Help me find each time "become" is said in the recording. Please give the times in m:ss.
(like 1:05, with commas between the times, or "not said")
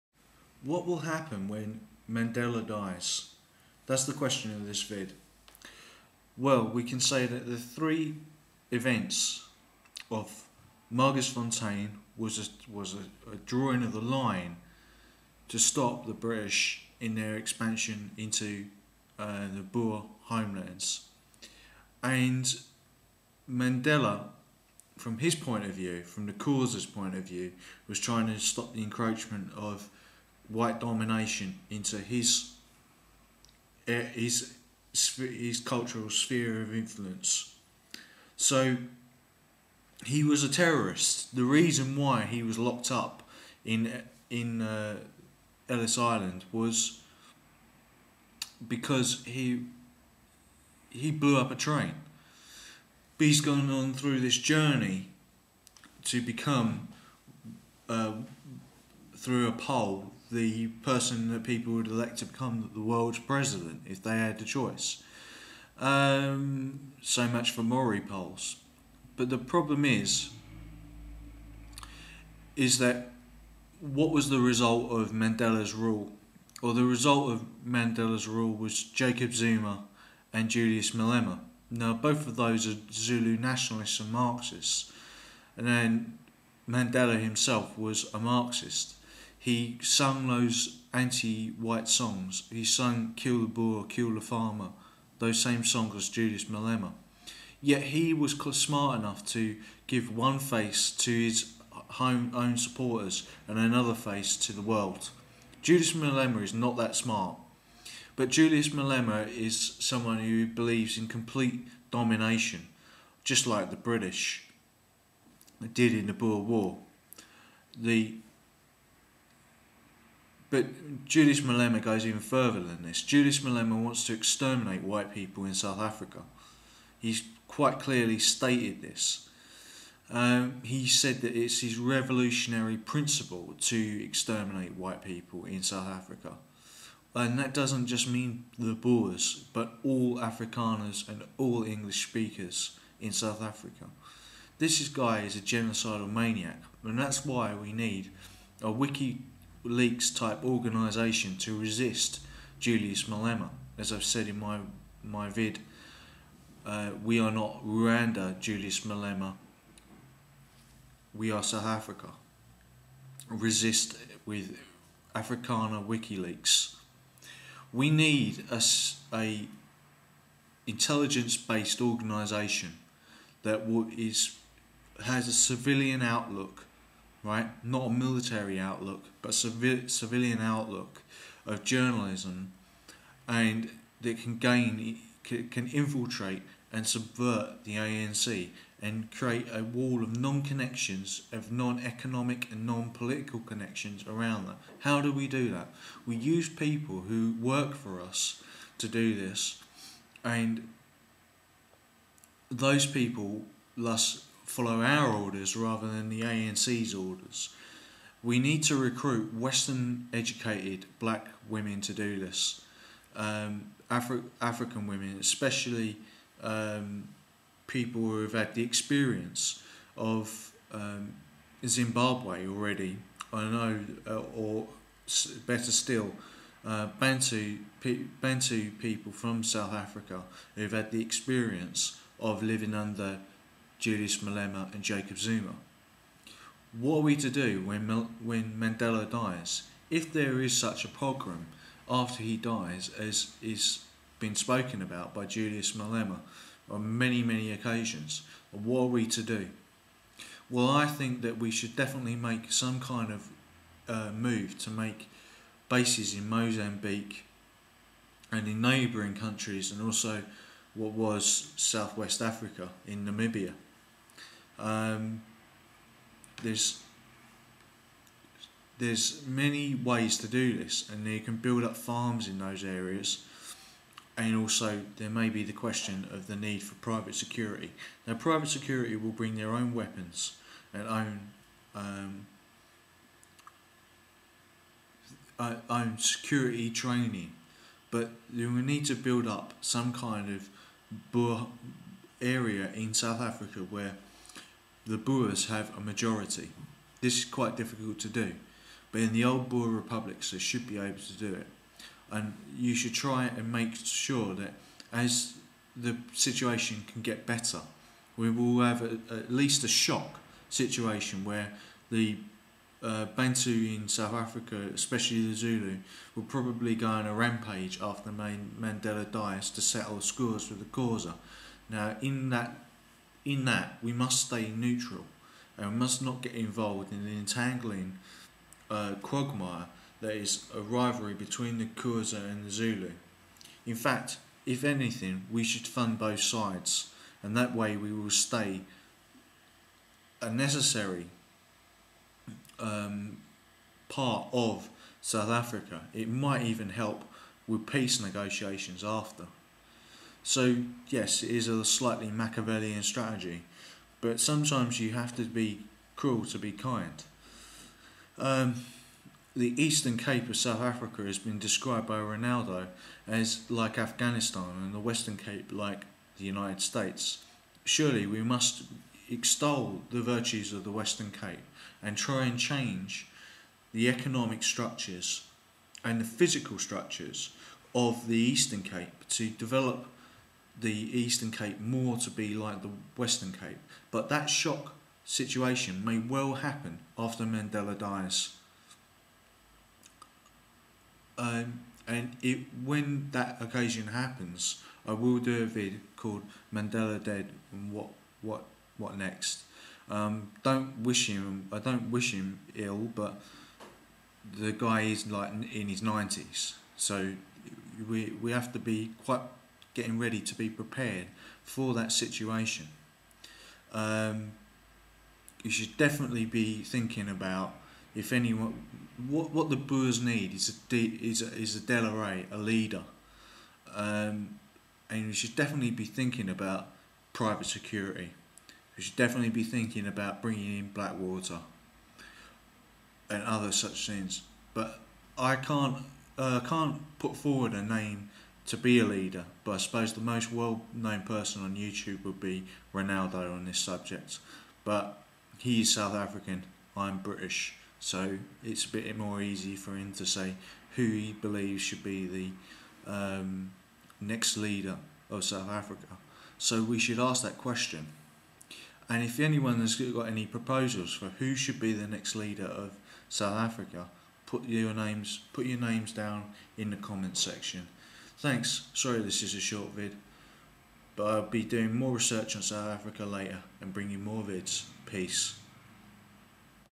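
0:56, 1:02.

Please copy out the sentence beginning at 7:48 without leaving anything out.
Thanks, sorry this is a short vid, but I'll be doing more research on South Africa later and bringing more vids.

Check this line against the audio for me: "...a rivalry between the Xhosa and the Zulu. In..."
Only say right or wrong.
right.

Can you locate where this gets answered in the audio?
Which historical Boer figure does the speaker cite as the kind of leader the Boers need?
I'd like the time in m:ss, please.
7:01.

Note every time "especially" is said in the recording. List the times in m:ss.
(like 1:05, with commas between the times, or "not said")
3:35, 5:14.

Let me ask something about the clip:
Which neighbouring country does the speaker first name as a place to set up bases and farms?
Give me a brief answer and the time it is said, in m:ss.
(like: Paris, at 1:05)
Mozambique, at 4:16.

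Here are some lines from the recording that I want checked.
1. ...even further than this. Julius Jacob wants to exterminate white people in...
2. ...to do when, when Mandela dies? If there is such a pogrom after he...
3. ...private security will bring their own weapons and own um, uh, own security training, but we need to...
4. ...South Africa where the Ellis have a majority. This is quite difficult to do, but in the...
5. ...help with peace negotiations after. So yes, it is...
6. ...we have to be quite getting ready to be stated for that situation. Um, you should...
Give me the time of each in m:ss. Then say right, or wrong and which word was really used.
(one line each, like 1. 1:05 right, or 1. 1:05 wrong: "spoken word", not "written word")
1. 2:02 wrong: "Malema", not "Jacob"
2. 3:57 right
3. 4:38 right
4. 4:52 wrong: "Boers", not "Ellis"
5. 5:46 right
6. 6:48 wrong: "prepared", not "stated".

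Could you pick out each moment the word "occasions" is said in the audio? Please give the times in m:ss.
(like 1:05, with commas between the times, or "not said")
4:07, 6:33.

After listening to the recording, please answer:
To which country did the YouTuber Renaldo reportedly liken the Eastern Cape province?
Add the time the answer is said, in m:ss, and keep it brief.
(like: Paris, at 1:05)
Afghanistan, at 6:03.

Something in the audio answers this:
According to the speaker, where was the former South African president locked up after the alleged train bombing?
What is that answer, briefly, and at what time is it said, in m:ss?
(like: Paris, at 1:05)
Ellis Island, at 0:45.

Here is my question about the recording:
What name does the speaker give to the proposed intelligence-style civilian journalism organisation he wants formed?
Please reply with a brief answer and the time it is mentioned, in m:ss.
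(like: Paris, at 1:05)
Afrikaner WikiLeaks, at 2:45.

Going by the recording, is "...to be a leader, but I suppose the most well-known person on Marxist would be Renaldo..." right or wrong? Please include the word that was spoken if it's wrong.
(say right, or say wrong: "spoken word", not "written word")
wrong: "YouTube", not "Marxist".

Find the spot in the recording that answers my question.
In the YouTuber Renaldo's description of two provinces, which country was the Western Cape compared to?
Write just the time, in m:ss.
6:06.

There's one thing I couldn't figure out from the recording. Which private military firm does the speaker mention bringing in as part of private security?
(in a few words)
Blackwater.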